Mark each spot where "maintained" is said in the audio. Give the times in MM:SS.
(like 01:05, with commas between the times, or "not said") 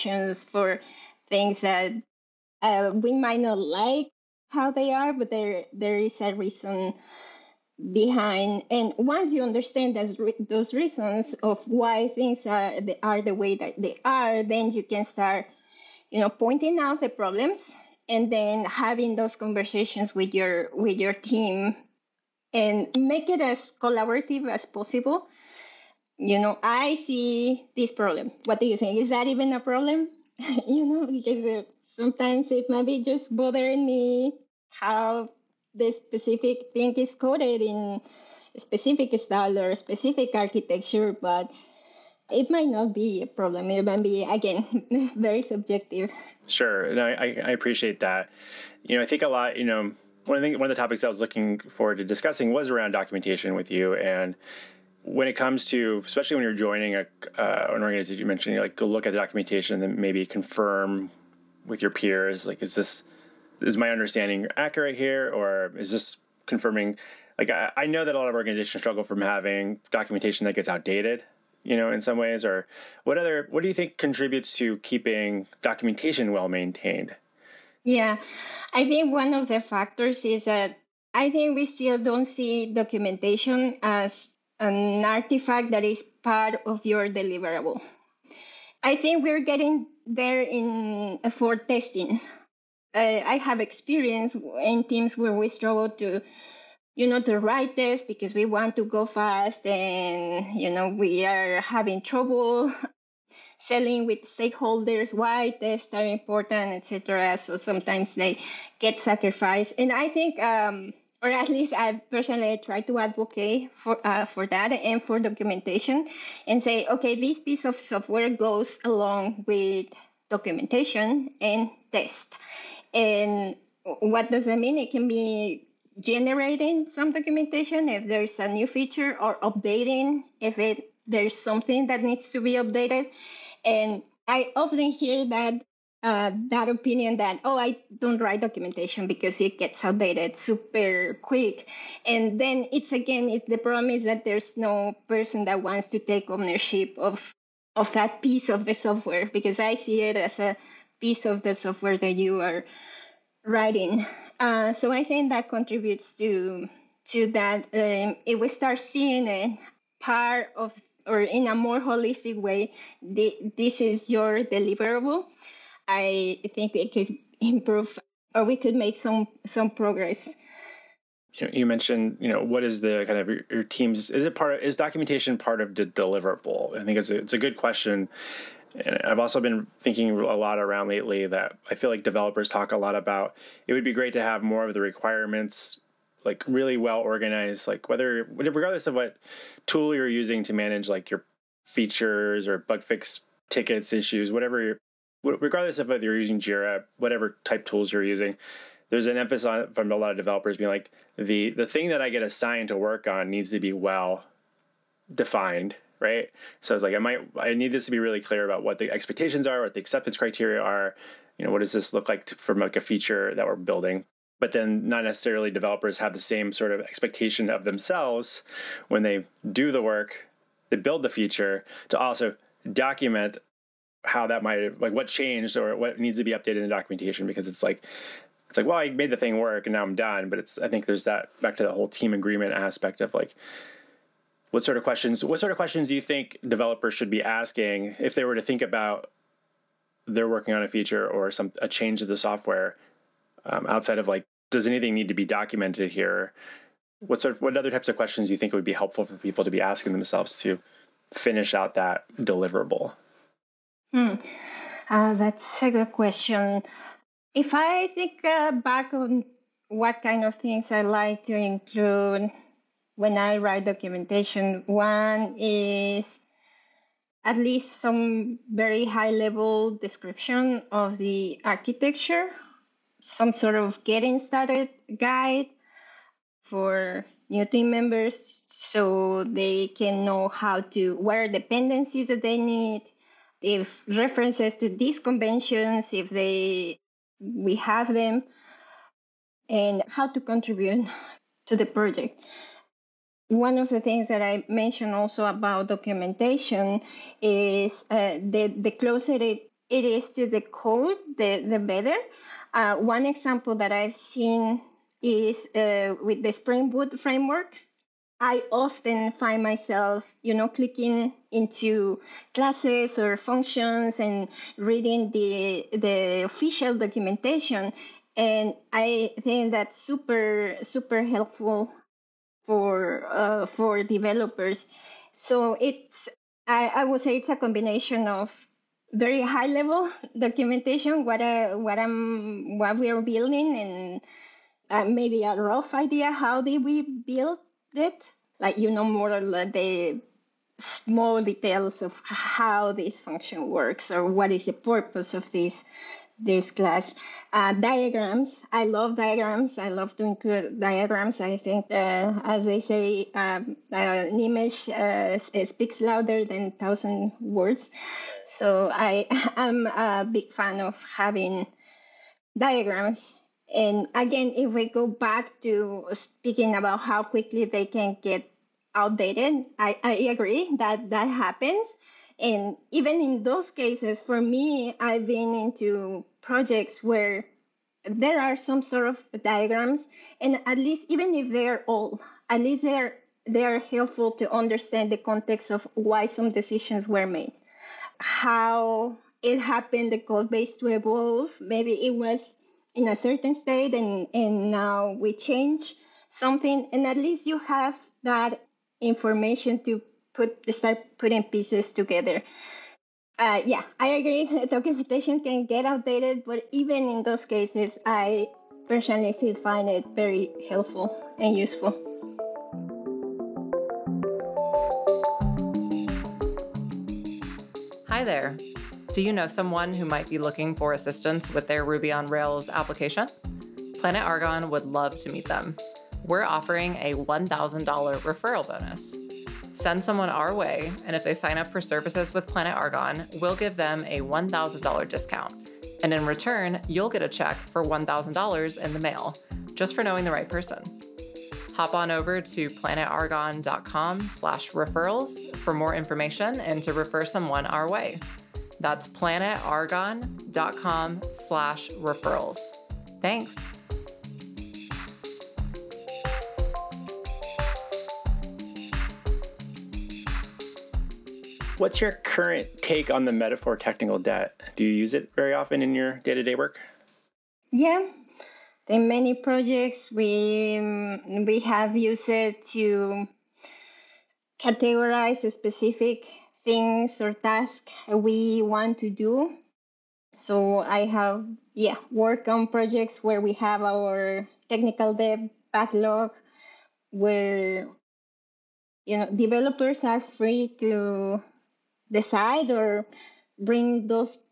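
01:16.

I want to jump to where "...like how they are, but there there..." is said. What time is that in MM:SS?
00:03.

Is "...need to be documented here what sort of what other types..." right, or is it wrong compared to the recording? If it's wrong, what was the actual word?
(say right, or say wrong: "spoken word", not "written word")
right.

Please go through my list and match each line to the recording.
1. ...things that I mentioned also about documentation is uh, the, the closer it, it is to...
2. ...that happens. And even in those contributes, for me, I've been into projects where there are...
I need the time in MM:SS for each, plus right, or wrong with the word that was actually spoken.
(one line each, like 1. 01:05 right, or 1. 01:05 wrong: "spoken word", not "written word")
1. 04:53 right
2. 06:10 wrong: "cases", not "contributes".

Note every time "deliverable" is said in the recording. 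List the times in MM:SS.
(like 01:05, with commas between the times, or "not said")
01:27, 02:44, 02:55, 04:12.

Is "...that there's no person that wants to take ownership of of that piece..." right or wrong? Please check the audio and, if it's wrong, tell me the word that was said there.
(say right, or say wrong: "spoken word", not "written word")
right.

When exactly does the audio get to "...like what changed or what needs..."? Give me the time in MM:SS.
03:44.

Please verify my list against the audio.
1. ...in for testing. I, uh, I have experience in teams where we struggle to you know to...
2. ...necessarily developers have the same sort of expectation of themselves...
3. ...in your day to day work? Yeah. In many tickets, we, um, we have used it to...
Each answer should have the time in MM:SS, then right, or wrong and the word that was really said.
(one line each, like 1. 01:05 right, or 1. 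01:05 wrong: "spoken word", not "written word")
1. 01:30 right
2. 03:35 right
3. 07:45 wrong: "projects", not "tickets".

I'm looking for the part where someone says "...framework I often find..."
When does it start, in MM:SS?
05:06.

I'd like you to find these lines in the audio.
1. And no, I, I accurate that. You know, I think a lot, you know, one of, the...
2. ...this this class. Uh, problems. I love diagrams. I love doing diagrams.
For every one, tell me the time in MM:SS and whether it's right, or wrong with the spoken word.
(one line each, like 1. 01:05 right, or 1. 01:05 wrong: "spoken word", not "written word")
1. 00:46 wrong: "appreciate", not "accurate"
2. 05:45 wrong: "diagrams", not "problems".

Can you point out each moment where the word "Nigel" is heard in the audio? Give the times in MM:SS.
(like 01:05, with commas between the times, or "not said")
not said.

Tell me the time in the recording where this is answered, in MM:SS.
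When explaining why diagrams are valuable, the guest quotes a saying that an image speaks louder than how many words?
05:56.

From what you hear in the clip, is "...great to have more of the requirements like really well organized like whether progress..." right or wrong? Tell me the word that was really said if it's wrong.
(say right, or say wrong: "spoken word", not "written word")
wrong: "regardless", not "progress".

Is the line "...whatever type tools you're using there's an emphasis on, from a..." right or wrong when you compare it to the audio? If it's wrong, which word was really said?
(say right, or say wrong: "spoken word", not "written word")
right.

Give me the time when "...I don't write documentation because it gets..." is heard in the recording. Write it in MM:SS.
02:17.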